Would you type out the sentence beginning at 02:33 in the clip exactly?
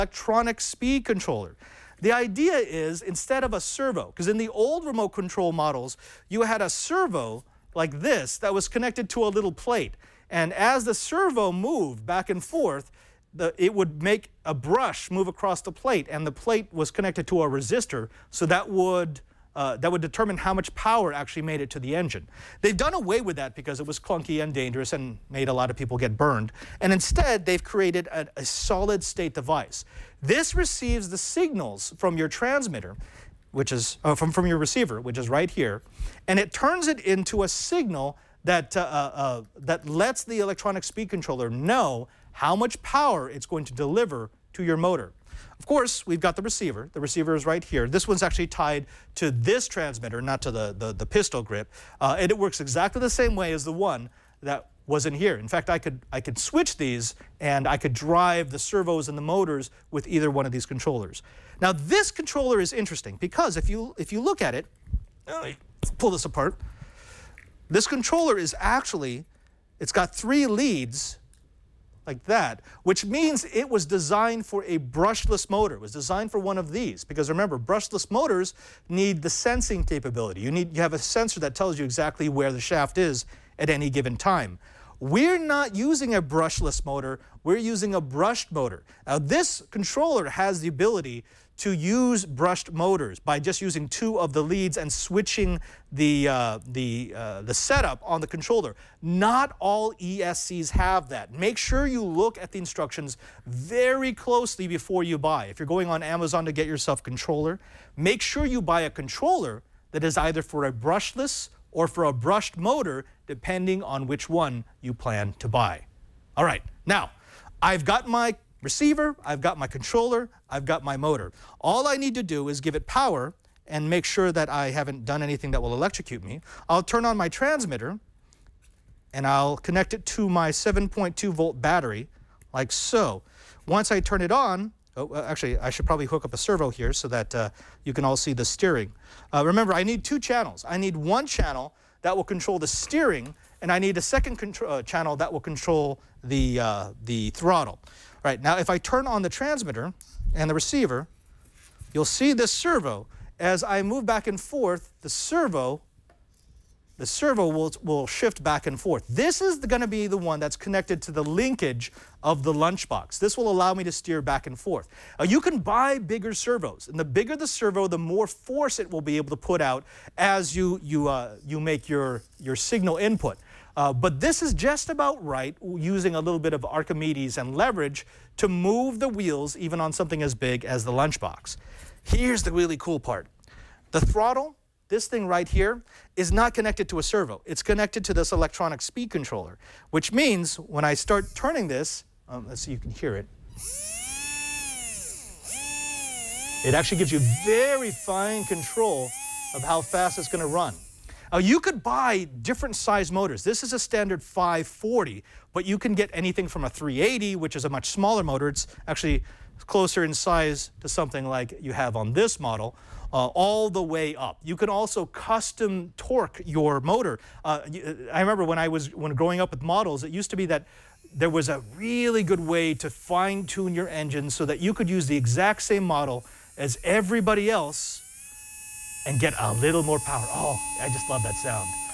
As I move back and forth, the servo, the servo will, will shift back and forth.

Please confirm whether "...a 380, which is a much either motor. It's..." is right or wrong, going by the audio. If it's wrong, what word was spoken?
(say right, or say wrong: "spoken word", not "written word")
wrong: "smaller", not "either".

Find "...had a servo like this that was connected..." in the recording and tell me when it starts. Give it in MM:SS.
00:06.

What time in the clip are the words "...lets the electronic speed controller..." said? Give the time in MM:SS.
00:39.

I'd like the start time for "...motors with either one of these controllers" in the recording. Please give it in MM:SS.
00:59.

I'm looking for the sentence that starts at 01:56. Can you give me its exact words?
All right, now, I've got my receiver, I've got my controller, I've got my motor.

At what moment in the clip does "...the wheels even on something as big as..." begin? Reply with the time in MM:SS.
02:59.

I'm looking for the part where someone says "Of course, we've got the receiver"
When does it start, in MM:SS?
00:45.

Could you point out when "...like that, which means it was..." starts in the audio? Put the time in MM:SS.
01:12.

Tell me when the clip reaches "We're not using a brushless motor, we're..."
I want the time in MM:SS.
01:25.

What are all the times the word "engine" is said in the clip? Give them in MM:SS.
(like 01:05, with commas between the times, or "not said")
00:21, 03:43.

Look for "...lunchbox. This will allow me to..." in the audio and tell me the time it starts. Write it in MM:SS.
02:42.